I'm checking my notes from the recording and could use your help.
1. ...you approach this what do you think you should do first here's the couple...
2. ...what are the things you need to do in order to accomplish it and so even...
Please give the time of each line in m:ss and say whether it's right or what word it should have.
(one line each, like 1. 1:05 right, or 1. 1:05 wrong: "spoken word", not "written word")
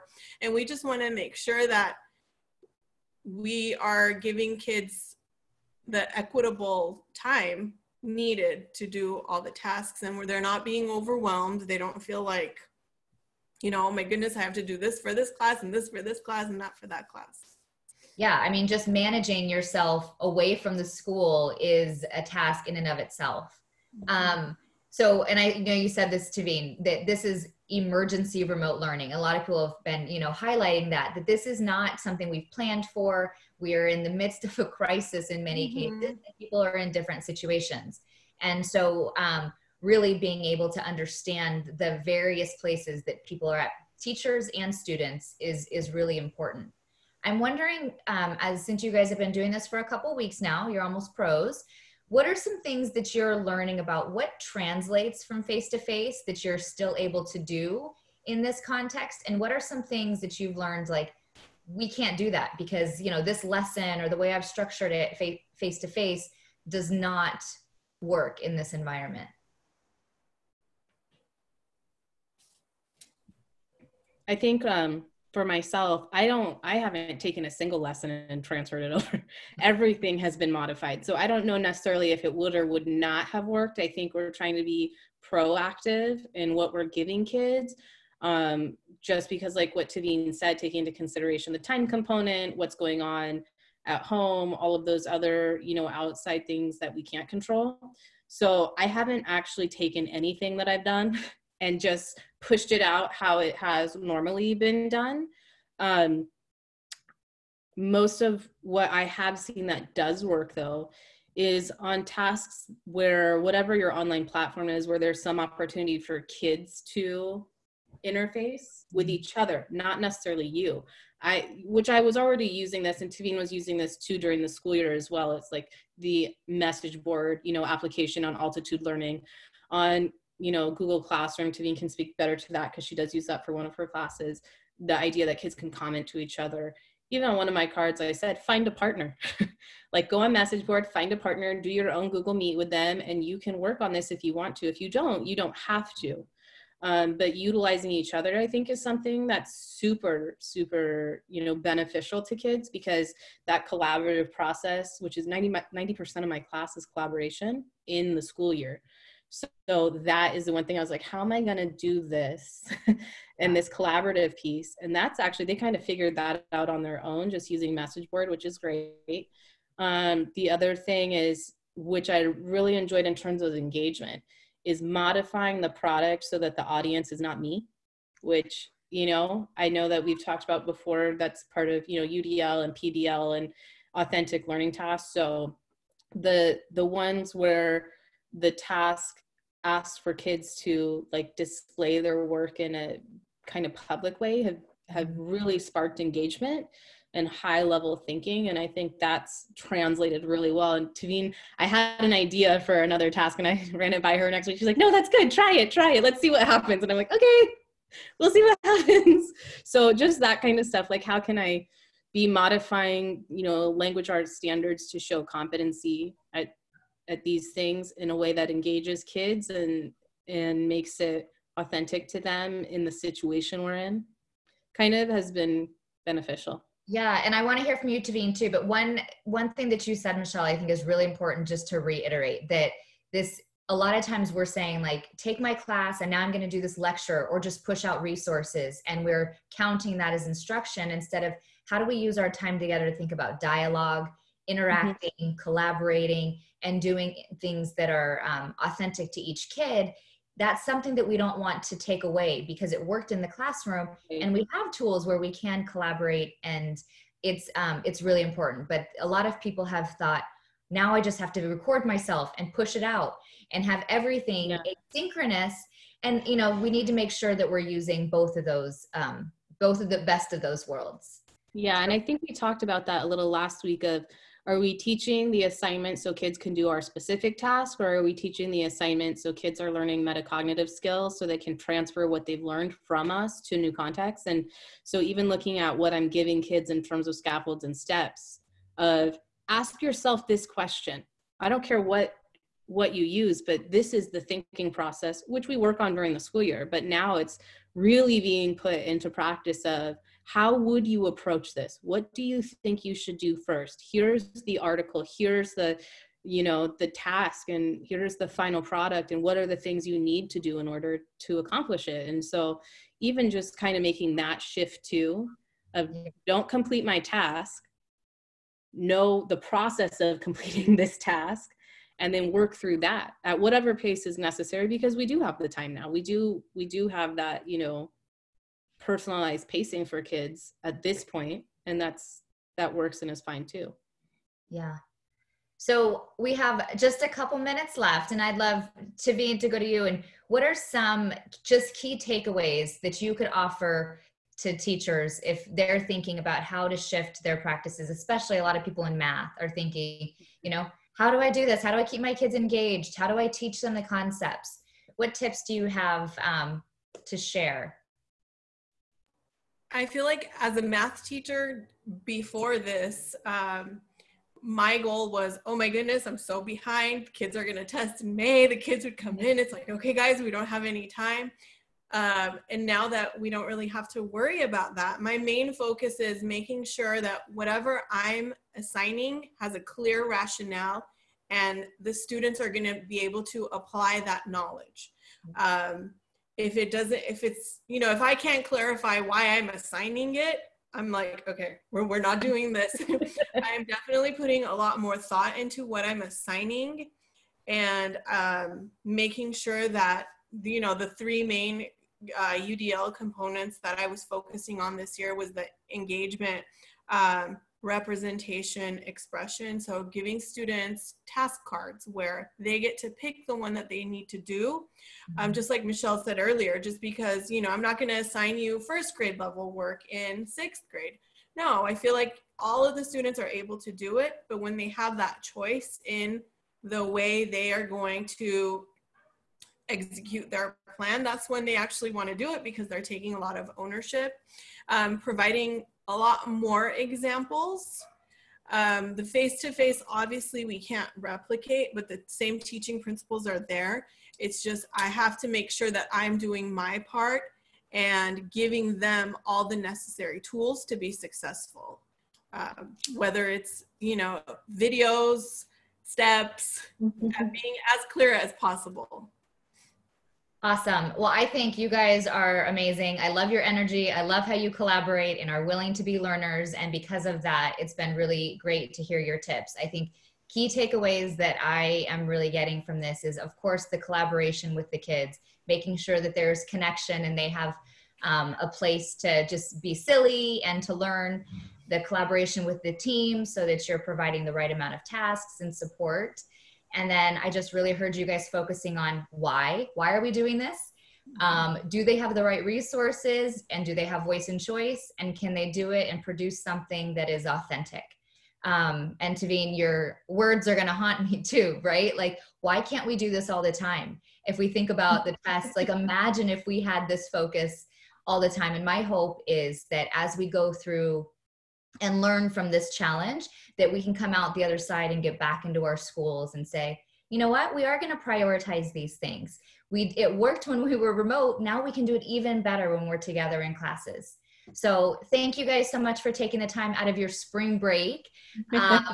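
1. 5:00 wrong: "article", not "couple"
2. 5:09 right.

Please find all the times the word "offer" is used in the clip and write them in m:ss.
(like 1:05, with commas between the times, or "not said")
5:43.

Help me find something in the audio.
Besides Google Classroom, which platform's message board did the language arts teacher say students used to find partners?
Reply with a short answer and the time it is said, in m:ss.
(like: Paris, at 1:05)
Altitude Learning, at 2:08.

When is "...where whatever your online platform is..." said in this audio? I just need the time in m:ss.
1:52.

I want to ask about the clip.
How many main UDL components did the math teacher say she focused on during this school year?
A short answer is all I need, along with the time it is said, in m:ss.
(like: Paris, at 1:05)
3, at 6:40.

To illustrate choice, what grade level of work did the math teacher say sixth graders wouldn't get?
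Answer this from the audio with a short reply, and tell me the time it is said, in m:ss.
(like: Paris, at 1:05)
First grade, at 6:58.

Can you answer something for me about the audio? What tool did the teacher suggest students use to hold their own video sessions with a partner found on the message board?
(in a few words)
Google Meet.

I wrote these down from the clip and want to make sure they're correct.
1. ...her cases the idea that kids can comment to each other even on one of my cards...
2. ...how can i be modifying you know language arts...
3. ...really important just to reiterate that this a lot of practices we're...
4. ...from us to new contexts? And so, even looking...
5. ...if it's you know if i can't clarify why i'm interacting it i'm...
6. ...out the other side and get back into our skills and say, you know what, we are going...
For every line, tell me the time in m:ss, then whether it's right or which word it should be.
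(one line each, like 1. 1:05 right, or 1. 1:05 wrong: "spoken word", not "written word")
1. 2:13 wrong: "classes", not "cases"
2. 3:31 right
3. 3:50 wrong: "times", not "practices"
4. 4:42 right
5. 6:27 wrong: "assigning", not "interacting"
6. 8:34 wrong: "schools", not "skills".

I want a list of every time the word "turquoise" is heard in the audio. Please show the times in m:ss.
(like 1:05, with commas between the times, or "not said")
not said.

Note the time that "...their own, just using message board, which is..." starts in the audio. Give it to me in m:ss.
2:46.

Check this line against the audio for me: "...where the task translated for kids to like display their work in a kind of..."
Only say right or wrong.
wrong.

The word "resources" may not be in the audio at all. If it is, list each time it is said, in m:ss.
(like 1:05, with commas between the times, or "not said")
3:58, 8:12.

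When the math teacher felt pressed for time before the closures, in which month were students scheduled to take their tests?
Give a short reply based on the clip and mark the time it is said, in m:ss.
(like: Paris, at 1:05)
May, at 6:08.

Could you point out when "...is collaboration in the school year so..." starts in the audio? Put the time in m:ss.
2:36.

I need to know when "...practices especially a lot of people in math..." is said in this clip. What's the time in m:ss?
5:47.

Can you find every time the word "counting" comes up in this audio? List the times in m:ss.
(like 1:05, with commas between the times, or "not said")
3:59.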